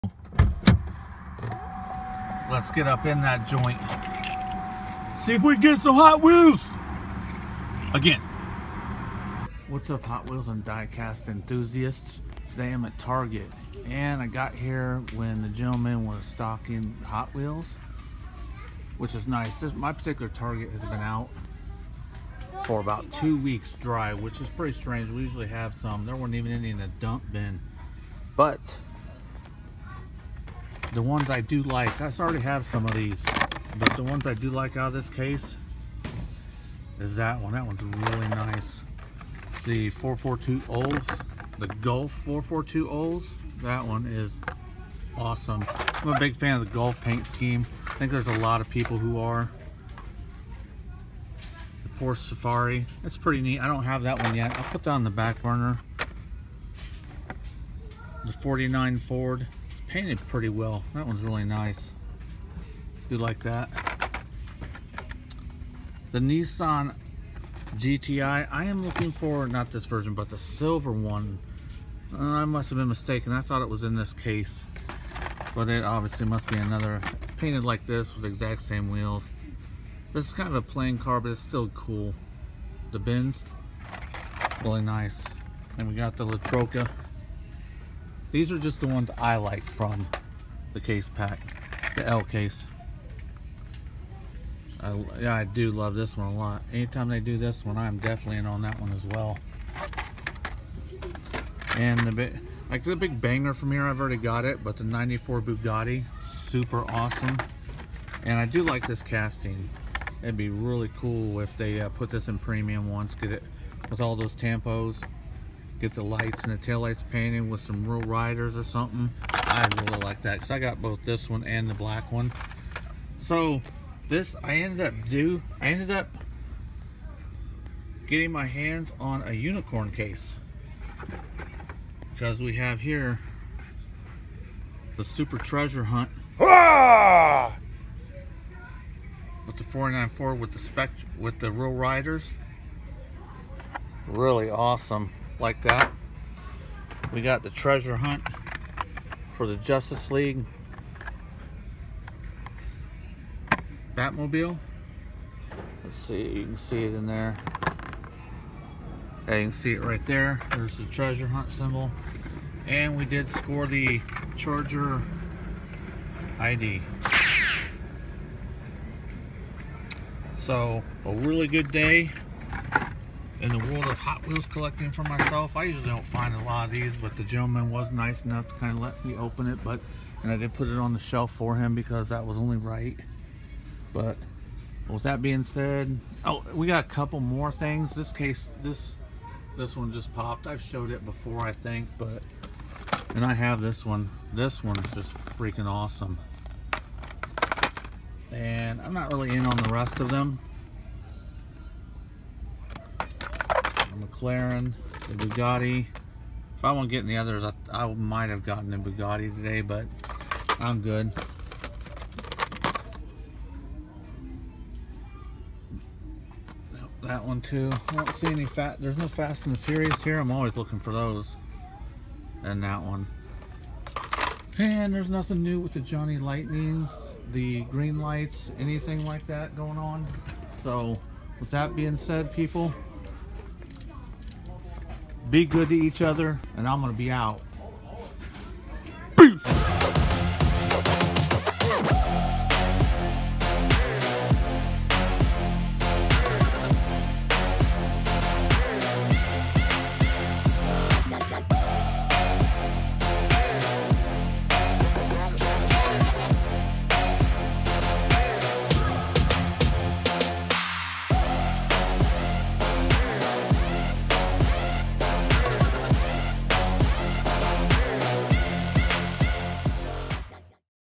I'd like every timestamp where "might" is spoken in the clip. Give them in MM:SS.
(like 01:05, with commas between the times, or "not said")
03:27.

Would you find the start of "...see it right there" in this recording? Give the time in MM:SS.
02:39.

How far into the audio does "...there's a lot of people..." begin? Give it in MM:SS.
00:48.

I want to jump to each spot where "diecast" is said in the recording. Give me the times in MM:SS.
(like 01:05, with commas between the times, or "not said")
00:10.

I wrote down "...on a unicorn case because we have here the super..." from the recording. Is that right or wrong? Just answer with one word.
right.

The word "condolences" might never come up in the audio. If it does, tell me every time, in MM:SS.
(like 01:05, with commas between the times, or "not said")
not said.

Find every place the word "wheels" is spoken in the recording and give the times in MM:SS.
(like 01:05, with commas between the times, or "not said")
00:06, 00:10, 00:17, 01:18, 02:54.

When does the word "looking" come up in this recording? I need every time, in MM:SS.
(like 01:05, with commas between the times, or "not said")
01:08, 03:40.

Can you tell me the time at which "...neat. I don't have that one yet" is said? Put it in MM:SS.
00:53.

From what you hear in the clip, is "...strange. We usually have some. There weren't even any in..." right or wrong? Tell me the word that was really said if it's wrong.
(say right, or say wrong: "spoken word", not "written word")
right.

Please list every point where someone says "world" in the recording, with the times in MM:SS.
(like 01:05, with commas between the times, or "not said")
02:53.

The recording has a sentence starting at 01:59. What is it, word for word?
I really like that because I got both this one and the black one.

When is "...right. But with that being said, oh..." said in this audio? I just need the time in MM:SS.
03:02.